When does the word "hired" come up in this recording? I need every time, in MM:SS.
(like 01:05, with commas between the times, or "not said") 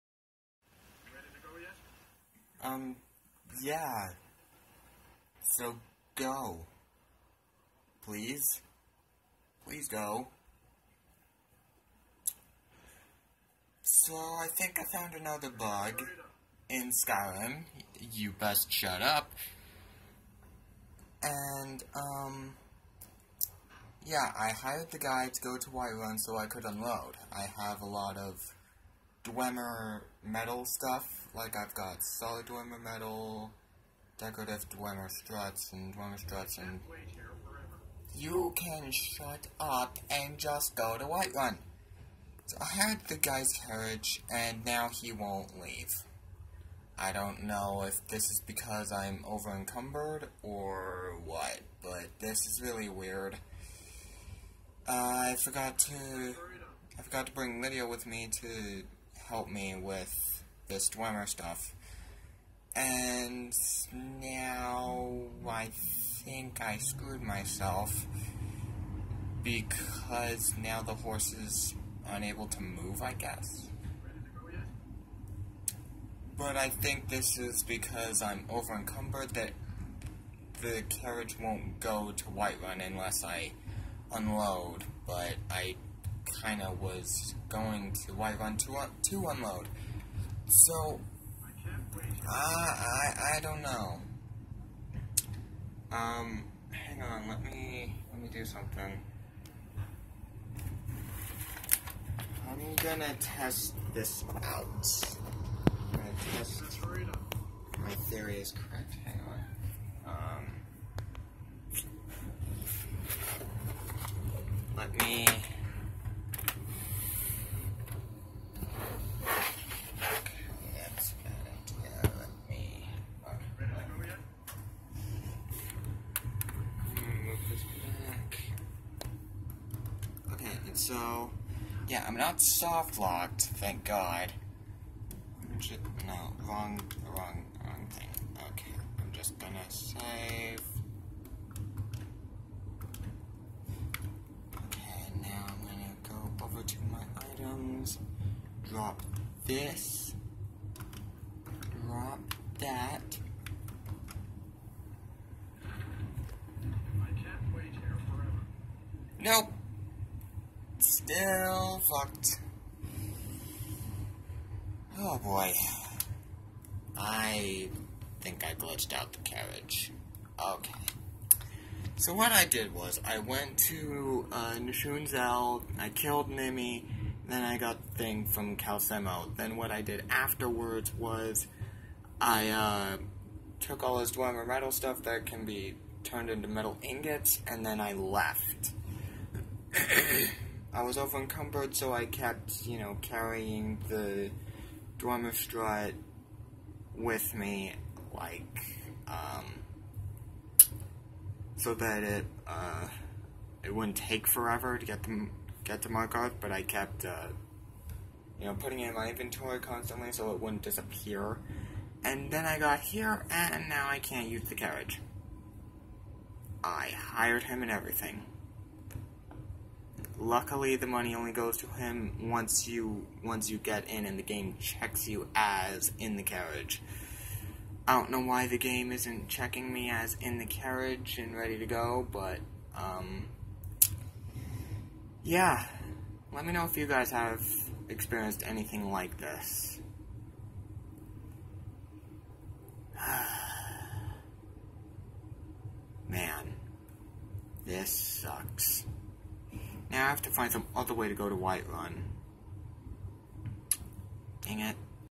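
00:24, 03:36.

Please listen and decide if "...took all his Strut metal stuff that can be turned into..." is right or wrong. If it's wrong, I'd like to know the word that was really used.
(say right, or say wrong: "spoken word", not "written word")
wrong: "Dwemer", not "Strut".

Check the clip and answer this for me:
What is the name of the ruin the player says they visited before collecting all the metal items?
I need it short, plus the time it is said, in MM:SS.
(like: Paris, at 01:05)
Nchuand-Zel, at 02:54.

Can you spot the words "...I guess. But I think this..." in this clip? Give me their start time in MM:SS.
01:13.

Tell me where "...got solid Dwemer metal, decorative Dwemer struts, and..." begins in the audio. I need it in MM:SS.
00:31.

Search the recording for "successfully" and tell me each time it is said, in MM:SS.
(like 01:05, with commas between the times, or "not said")
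not said.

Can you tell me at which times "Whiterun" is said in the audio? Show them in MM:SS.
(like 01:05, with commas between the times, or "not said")
00:25, 00:41, 01:22, 01:28.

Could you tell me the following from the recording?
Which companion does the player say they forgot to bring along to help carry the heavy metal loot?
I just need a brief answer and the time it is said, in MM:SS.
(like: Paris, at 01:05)
Lydia, at 00:57.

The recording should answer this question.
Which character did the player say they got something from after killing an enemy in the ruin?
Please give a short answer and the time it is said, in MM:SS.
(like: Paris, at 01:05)
Calcelmo, at 02:58.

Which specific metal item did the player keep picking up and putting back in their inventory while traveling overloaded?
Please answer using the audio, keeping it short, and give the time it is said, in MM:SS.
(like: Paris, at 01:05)
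Dwemer Strut, at 03:14.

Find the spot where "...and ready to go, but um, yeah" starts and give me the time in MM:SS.
03:51.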